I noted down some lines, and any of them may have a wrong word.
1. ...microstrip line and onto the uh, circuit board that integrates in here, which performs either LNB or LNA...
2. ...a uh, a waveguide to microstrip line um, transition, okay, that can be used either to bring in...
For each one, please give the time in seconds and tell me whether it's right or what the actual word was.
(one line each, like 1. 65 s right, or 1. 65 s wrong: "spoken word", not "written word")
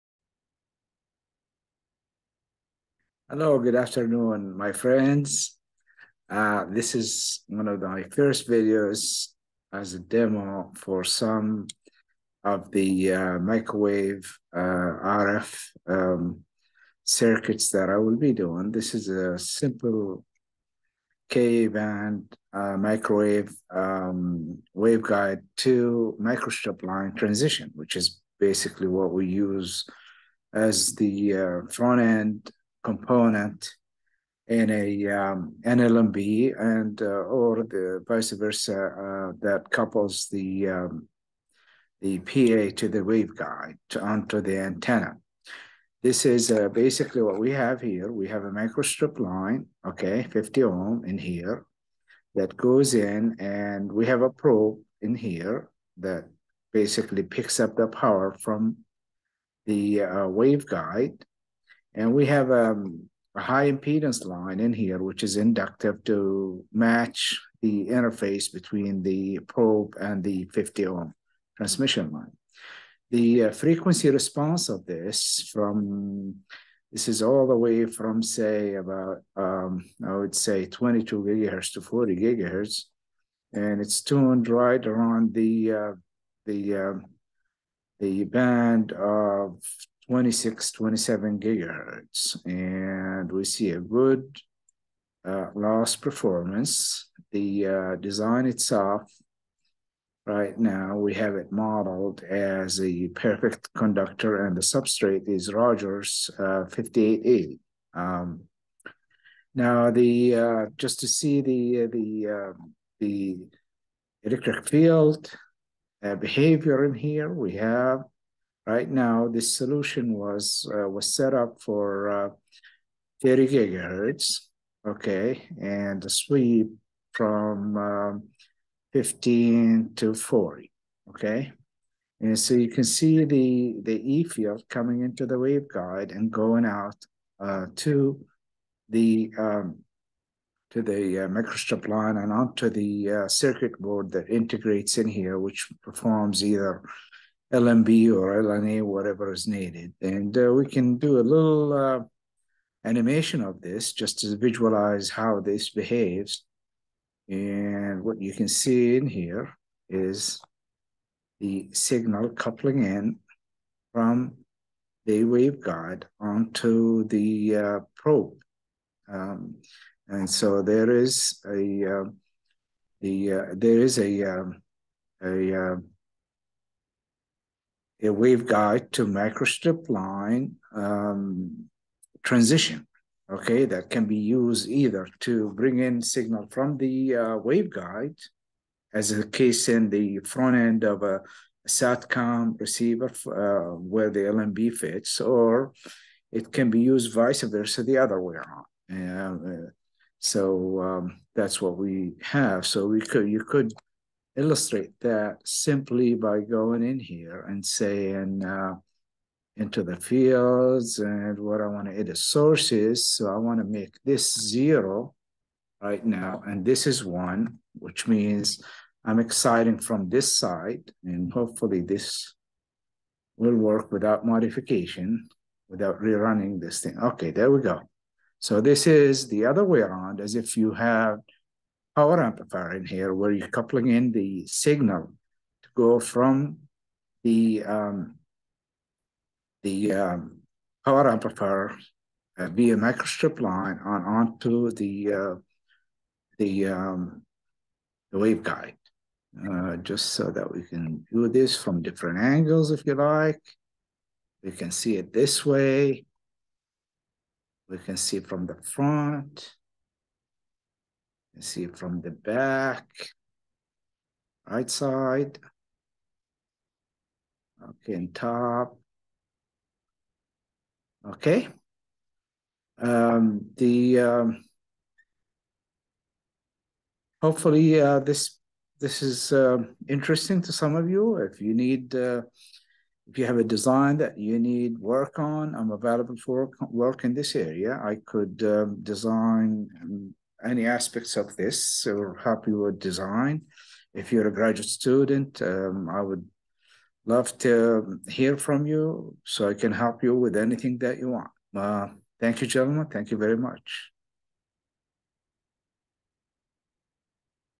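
1. 141 s right
2. 175 s right.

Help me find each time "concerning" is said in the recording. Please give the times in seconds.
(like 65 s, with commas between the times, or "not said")
not said.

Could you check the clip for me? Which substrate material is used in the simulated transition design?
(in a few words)
Rogers 5880.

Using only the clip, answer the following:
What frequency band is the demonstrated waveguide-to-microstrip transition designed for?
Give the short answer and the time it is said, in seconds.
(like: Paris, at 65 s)
K-band, at 21 s.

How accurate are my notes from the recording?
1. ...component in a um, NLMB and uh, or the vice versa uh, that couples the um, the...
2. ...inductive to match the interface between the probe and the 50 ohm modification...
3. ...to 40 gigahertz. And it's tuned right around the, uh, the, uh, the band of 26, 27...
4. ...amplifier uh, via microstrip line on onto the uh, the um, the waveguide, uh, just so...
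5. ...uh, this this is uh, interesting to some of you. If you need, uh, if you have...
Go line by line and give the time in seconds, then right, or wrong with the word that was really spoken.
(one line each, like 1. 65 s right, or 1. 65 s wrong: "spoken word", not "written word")
1. 32 s right
2. 65 s wrong: "transmission", not "modification"
3. 81 s right
4. 241 s right
5. 277 s right.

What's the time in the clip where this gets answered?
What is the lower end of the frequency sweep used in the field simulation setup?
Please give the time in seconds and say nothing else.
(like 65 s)
128 s.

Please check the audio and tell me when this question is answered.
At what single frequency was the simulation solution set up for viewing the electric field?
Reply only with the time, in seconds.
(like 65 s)
123 s.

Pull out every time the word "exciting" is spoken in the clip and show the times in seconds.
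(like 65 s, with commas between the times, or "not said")
219 s.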